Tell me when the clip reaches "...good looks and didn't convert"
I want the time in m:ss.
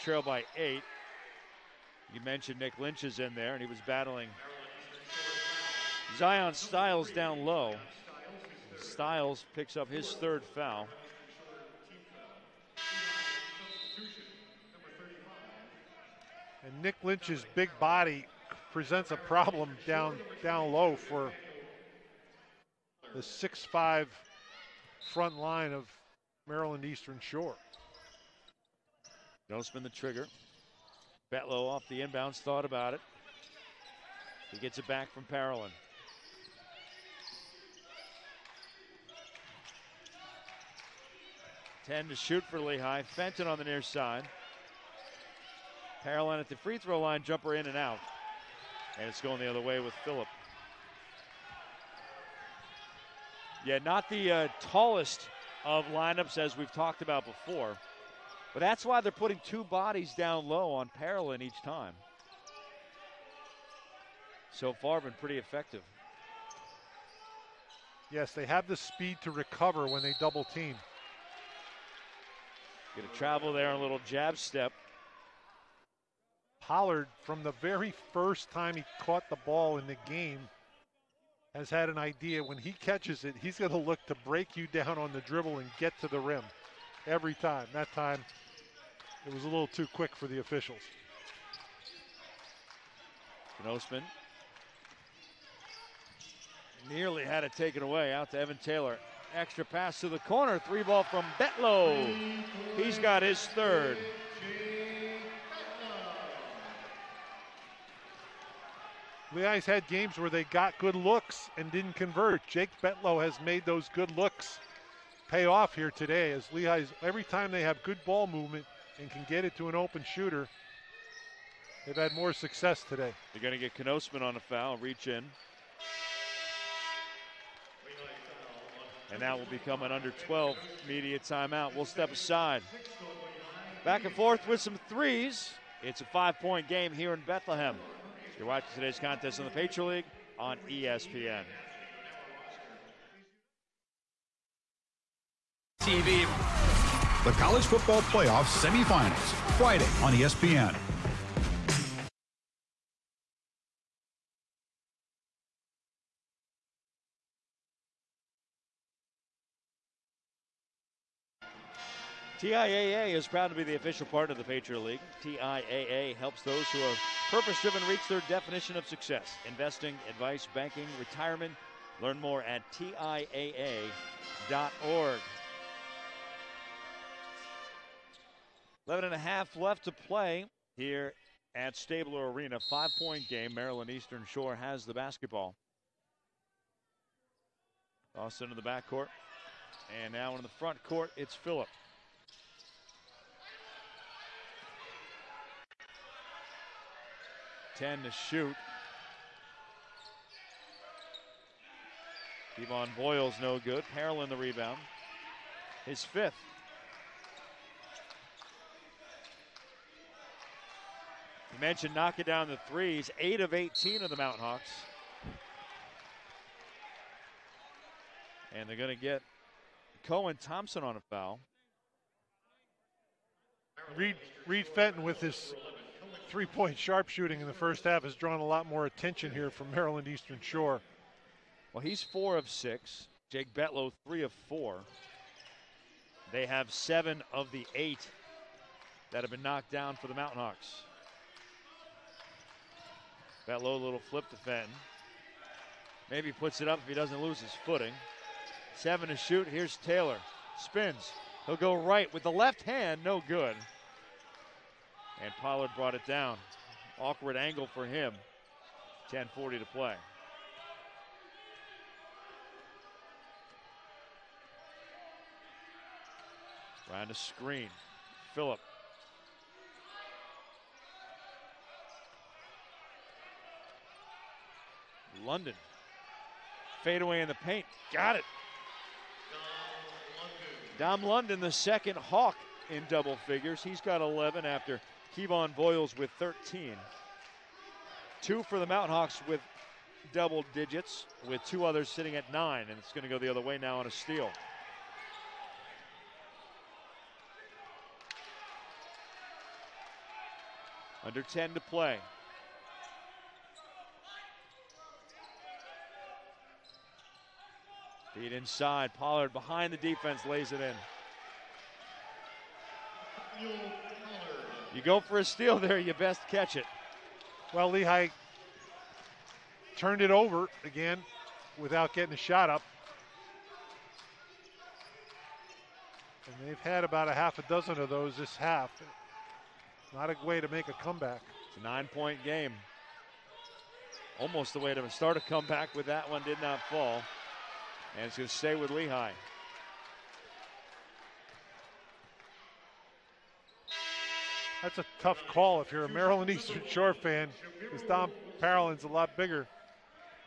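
1:50.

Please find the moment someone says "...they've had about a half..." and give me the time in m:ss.
5:26.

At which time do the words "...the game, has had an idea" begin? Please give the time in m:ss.
1:19.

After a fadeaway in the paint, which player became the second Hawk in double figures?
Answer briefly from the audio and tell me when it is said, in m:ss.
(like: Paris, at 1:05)
Dom London, at 4:40.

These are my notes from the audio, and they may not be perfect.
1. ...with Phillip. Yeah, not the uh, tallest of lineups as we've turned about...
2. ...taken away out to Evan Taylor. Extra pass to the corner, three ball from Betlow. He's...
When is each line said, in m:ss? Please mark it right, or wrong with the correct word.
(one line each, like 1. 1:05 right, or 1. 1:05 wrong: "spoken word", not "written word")
1. 0:49 wrong: "talked", not "turned"
2. 1:37 right.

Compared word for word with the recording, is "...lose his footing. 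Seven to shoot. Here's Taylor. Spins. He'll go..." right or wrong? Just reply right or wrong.
right.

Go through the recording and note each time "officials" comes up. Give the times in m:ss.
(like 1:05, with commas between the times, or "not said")
1:30, 2:43.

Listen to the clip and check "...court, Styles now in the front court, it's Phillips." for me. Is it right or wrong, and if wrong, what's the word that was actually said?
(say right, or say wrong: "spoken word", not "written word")
wrong: "And", not "Styles".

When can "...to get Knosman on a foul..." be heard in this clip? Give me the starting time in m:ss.
2:03.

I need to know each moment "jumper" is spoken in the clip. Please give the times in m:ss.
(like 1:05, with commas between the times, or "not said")
0:47.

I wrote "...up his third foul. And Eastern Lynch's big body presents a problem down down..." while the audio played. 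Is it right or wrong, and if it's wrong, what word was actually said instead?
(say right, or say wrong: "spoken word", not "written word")
wrong: "Nick", not "Eastern".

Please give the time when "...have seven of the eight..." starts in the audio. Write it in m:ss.
3:56.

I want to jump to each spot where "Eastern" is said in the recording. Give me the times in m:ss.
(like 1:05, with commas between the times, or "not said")
0:26, 3:03, 3:50, 5:46.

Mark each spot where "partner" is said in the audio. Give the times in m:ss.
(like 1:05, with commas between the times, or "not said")
2:44.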